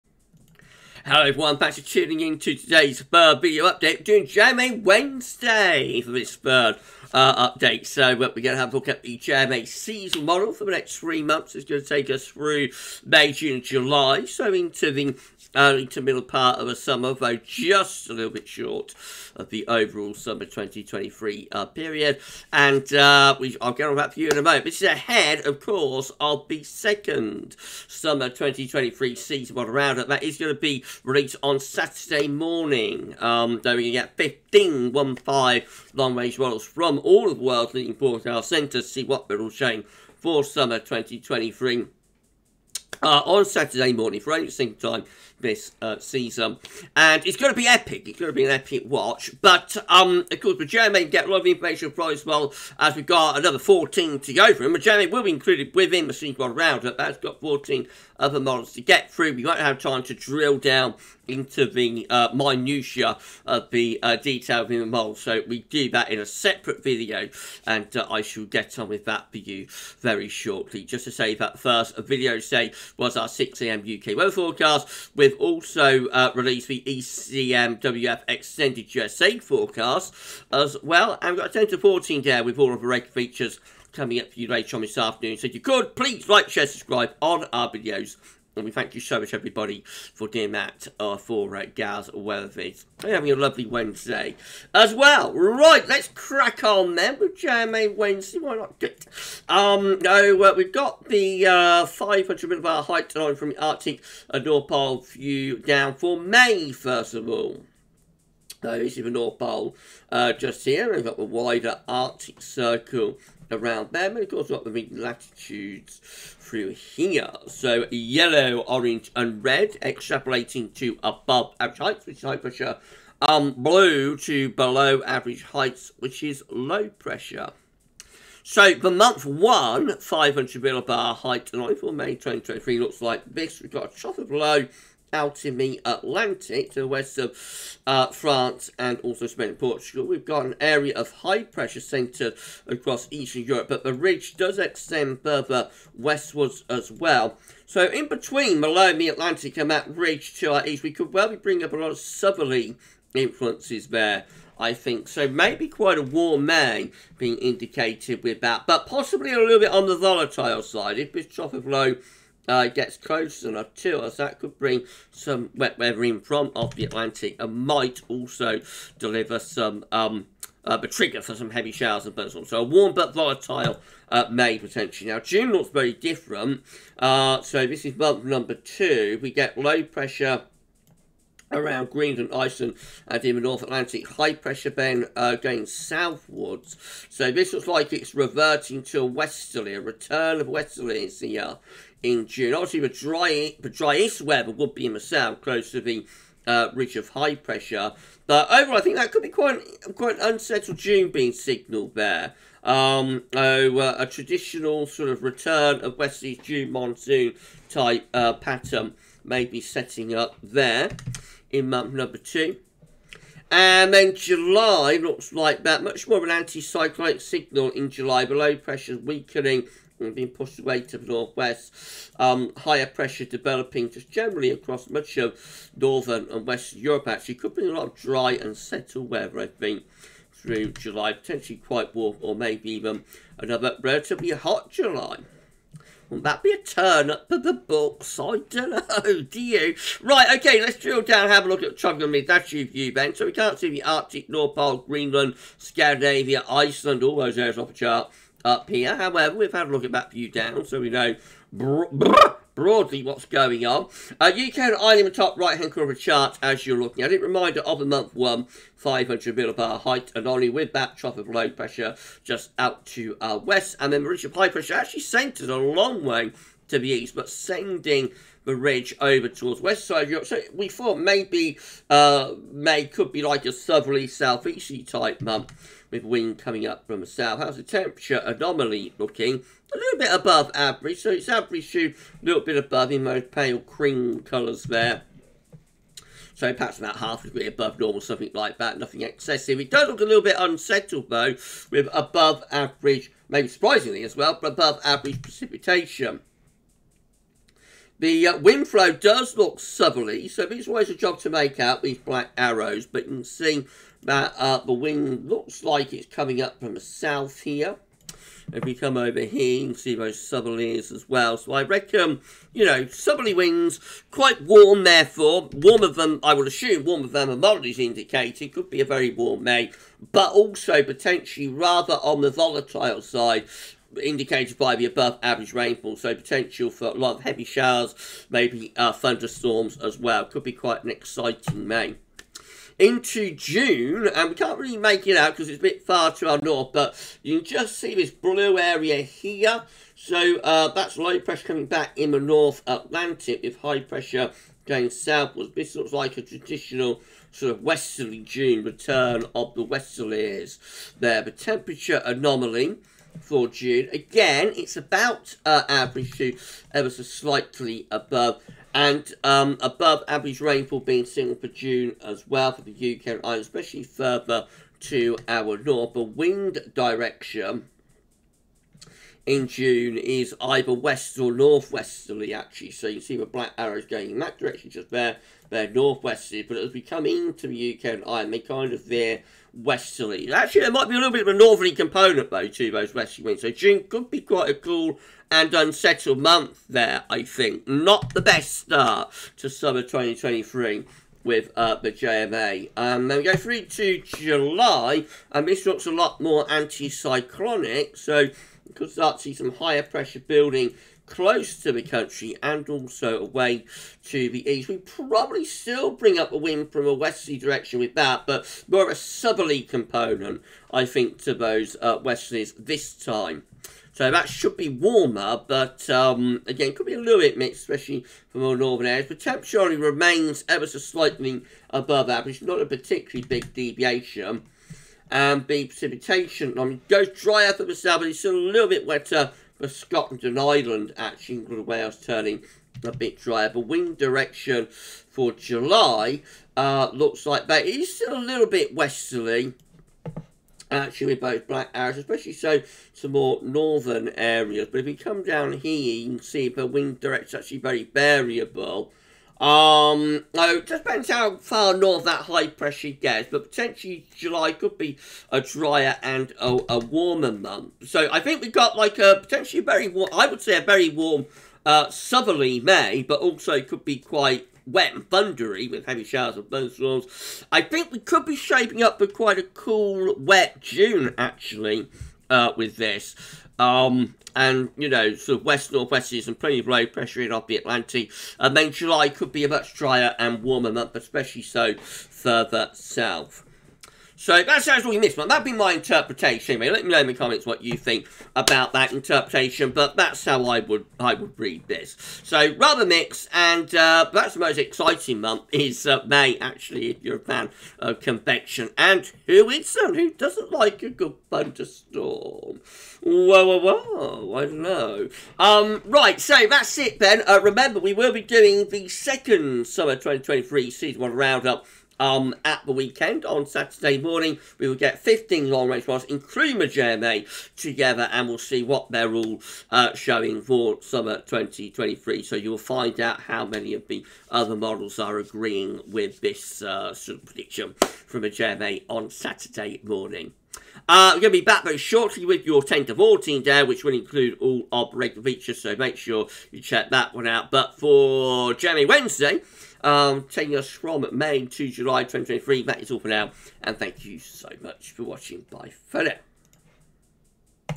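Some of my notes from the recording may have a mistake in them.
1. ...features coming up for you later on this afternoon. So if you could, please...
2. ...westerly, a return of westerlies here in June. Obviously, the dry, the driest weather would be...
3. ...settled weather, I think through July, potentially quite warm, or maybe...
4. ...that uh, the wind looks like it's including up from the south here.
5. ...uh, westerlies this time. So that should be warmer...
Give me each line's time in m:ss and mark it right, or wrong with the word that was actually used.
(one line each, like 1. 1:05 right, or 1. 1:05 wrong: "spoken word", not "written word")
1. 1:23 right
2. 3:09 right
3. 3:48 right
4. 5:04 wrong: "coming", not "including"
5. 6:51 right.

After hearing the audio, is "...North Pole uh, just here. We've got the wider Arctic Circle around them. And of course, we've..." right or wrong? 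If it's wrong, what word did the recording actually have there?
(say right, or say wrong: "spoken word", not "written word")
right.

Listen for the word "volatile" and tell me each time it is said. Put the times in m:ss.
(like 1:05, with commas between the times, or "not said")
2:39, 2:53, 5:22.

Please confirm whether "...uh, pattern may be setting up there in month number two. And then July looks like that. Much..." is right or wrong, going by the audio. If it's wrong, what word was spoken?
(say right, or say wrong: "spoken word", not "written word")
right.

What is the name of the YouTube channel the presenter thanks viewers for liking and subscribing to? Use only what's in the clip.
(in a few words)
GavsWeatherVids.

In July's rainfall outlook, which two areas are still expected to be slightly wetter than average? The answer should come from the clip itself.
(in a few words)
Scotland and Ireland.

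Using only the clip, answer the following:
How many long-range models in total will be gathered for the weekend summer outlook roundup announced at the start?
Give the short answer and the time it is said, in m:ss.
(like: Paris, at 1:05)
15, at 0:34.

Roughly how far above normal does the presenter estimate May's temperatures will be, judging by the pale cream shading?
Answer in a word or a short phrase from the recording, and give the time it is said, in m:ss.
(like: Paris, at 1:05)
half a degree, at 4:46.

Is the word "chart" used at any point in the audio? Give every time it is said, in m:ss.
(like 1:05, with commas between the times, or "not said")
4:07, 4:16.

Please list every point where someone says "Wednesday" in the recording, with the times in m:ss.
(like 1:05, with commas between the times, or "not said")
0:04, 1:33, 1:37, 8:58.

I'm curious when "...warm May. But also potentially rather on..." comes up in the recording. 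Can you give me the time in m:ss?
5:19.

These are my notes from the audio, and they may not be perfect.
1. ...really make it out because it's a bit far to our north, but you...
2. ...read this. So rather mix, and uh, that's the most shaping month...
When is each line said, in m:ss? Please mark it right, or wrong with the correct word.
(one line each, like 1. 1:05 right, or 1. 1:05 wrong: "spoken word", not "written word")
1. 5:34 right
2. 8:11 wrong: "exciting", not "shaping".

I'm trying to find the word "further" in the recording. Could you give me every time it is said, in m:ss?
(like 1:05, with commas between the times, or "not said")
2:25, 6:03, 8:01.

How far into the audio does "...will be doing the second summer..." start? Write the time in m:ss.
8:27.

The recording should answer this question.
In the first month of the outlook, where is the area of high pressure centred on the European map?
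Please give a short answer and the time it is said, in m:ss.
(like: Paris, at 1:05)
eastern Europe, at 2:23.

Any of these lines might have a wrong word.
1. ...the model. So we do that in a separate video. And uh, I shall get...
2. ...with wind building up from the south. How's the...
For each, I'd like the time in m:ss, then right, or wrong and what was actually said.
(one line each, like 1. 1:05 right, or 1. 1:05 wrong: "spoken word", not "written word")
1. 1:04 right
2. 4:35 wrong: "coming", not "building".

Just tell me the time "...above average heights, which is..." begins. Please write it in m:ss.
2:01.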